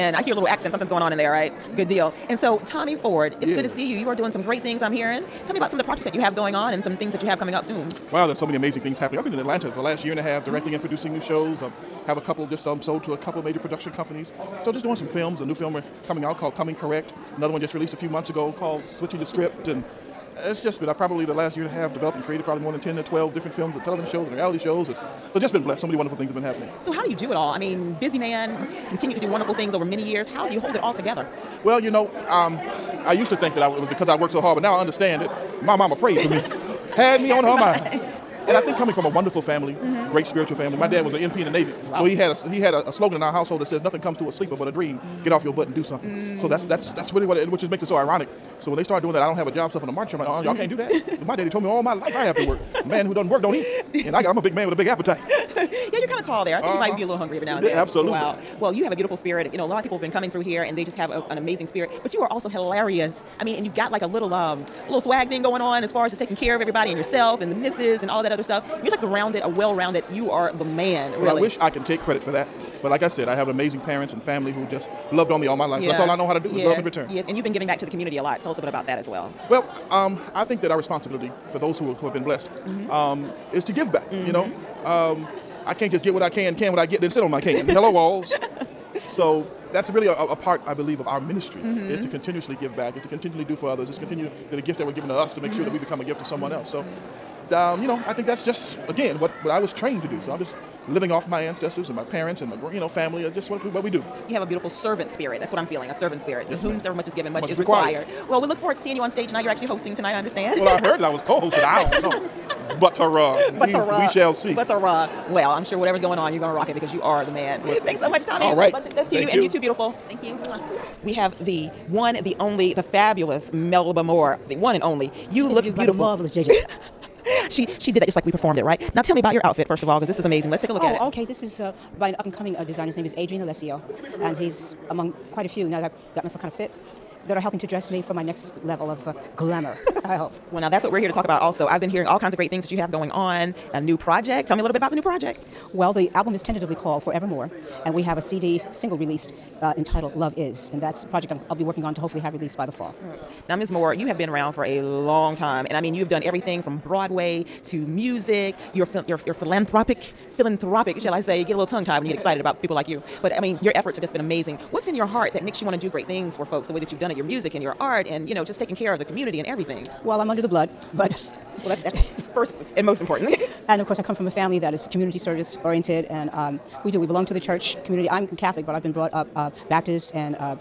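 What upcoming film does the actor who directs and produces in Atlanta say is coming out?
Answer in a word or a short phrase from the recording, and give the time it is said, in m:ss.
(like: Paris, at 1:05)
Coming Correct, at 0:16.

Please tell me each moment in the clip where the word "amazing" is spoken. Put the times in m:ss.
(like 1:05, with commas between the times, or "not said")
0:08, 1:01, 1:13, 2:10, 2:44.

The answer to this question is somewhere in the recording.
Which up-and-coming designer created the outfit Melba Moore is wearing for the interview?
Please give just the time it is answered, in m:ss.
2:13.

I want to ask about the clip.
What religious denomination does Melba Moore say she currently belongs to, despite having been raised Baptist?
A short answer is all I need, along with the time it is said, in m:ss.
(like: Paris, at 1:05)
Catholic, at 2:58.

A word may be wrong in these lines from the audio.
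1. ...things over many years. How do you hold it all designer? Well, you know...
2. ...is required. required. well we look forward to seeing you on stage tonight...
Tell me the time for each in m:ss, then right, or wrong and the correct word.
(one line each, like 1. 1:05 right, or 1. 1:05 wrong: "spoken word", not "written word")
1. 0:29 wrong: "together", not "designer"
2. 1:47 right.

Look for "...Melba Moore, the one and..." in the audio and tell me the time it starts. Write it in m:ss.
2:03.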